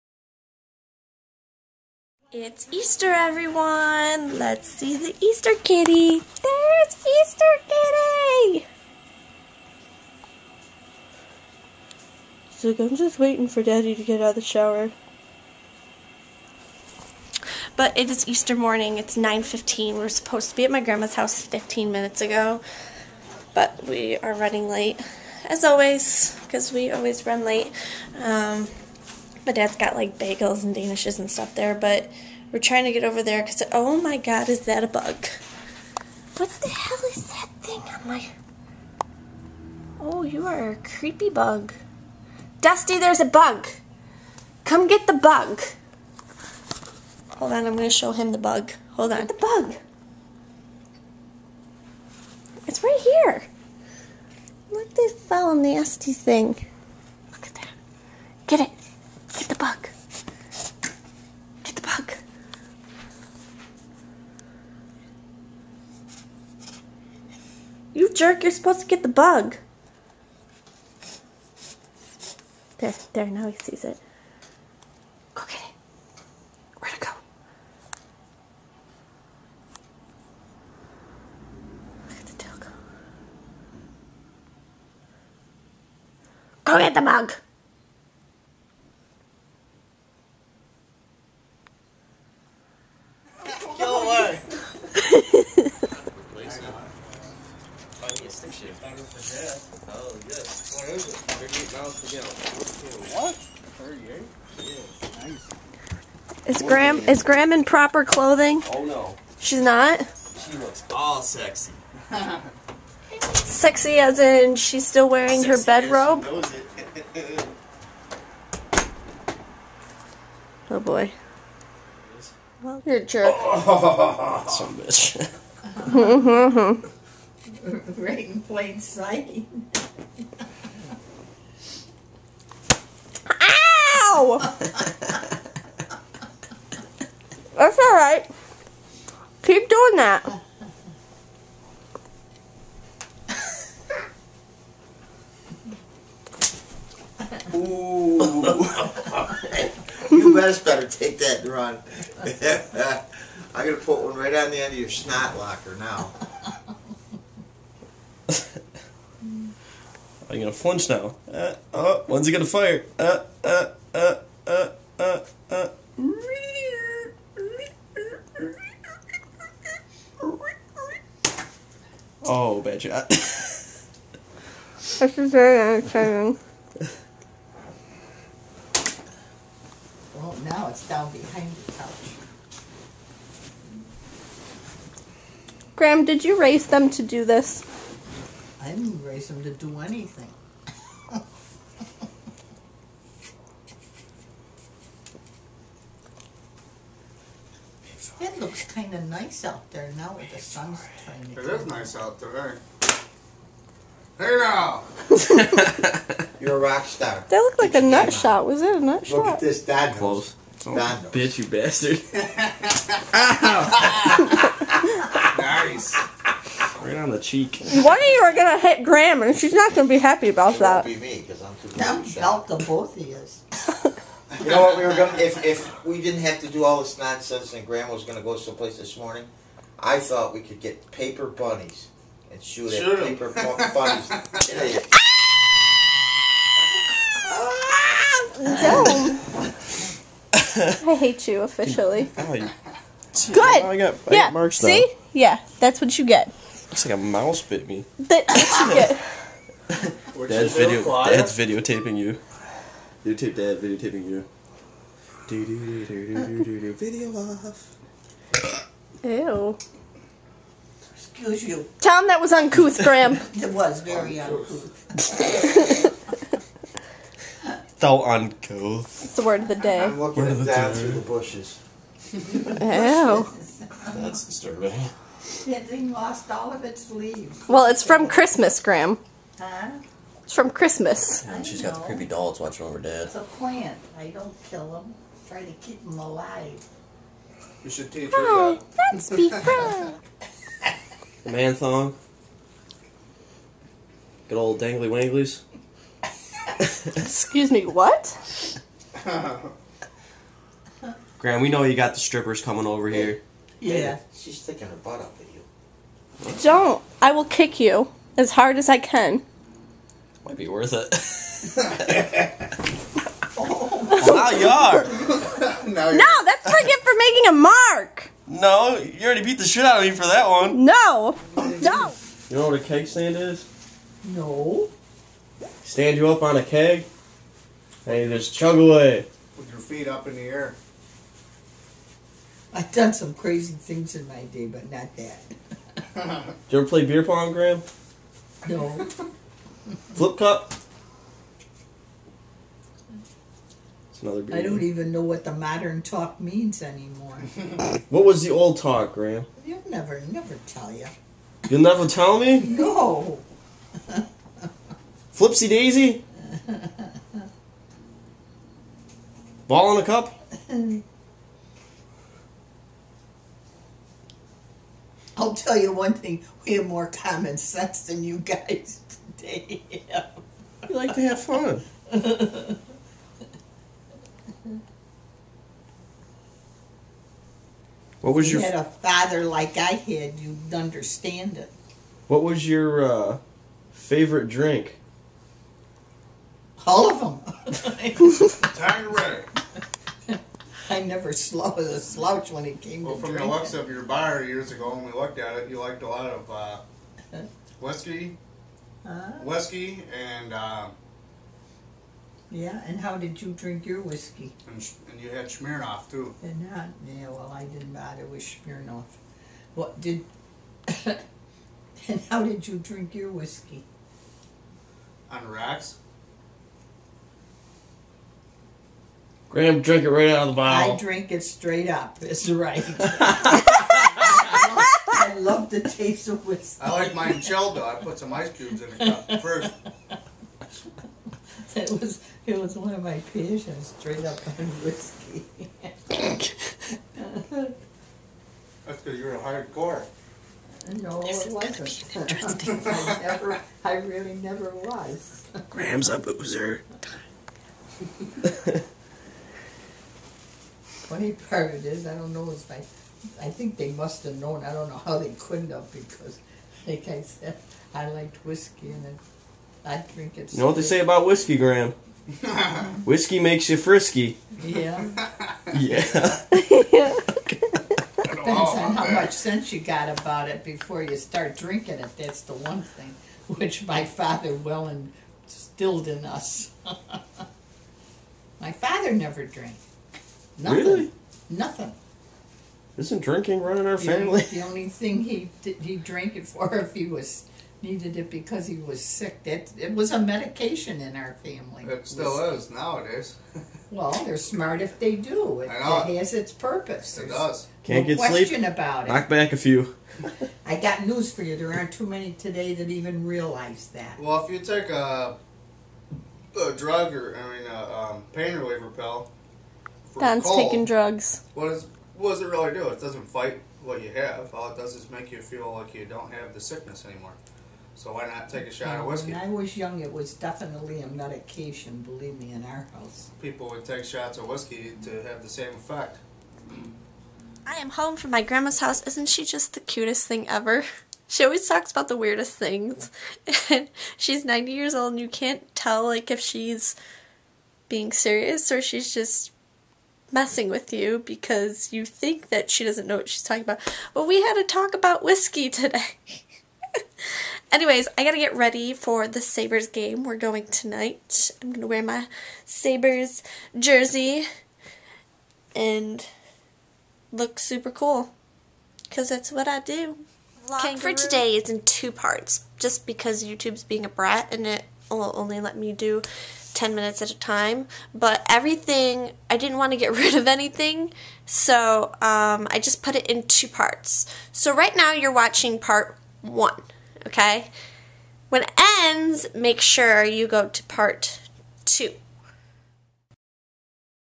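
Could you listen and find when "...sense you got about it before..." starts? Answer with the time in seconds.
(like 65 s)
469 s.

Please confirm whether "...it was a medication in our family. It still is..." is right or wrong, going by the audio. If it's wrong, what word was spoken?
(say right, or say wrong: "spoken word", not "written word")
right.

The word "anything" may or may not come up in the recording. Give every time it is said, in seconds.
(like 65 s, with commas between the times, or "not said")
189 s, 570 s.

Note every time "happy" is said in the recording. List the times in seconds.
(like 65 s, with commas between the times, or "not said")
219 s.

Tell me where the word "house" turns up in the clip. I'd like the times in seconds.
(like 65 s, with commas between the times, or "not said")
21 s, 522 s, 528 s.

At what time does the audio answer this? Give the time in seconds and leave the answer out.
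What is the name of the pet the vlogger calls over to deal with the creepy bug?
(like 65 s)
42 s.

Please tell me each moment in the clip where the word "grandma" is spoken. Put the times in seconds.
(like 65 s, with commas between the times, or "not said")
20 s, 227 s, 528 s.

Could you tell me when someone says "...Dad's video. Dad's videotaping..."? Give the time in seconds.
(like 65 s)
250 s.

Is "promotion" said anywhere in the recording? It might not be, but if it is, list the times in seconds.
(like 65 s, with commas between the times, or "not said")
not said.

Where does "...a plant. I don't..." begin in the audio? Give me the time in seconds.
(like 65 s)
283 s.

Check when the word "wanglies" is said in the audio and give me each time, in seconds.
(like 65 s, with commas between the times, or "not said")
294 s.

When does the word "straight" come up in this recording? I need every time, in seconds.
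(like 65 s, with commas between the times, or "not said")
421 s, 433 s.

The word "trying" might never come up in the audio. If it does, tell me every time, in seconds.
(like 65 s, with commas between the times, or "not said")
32 s, 201 s.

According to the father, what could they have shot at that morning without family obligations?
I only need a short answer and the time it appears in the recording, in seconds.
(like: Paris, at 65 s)
paper bunnies, at 230 s.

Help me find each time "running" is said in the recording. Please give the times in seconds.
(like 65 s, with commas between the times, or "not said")
24 s, 483 s.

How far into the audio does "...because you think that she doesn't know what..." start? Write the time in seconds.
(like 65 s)
540 s.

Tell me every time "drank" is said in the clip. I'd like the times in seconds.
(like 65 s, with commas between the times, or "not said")
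479 s, 485 s.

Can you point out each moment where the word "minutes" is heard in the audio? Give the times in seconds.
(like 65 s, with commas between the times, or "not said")
21 s, 566 s.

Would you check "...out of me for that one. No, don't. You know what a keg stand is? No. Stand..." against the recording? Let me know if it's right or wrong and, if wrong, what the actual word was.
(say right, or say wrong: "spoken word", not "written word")
right.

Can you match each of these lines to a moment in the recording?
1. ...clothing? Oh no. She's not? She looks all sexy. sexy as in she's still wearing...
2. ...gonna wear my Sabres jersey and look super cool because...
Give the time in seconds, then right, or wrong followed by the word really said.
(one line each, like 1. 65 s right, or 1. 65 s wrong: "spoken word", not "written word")
1. 108 s right
2. 551 s right.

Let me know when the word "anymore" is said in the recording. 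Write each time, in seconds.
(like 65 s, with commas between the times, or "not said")
346 s, 516 s.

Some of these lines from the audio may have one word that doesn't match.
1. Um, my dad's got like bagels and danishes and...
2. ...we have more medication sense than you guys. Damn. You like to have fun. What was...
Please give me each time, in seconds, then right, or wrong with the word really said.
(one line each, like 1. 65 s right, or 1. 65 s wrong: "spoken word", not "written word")
1. 28 s right
2. 366 s wrong: "common", not "medication".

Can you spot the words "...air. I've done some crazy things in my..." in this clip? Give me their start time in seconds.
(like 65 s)
330 s.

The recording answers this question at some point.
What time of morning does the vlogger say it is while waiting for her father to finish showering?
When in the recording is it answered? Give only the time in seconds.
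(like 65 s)
19 s.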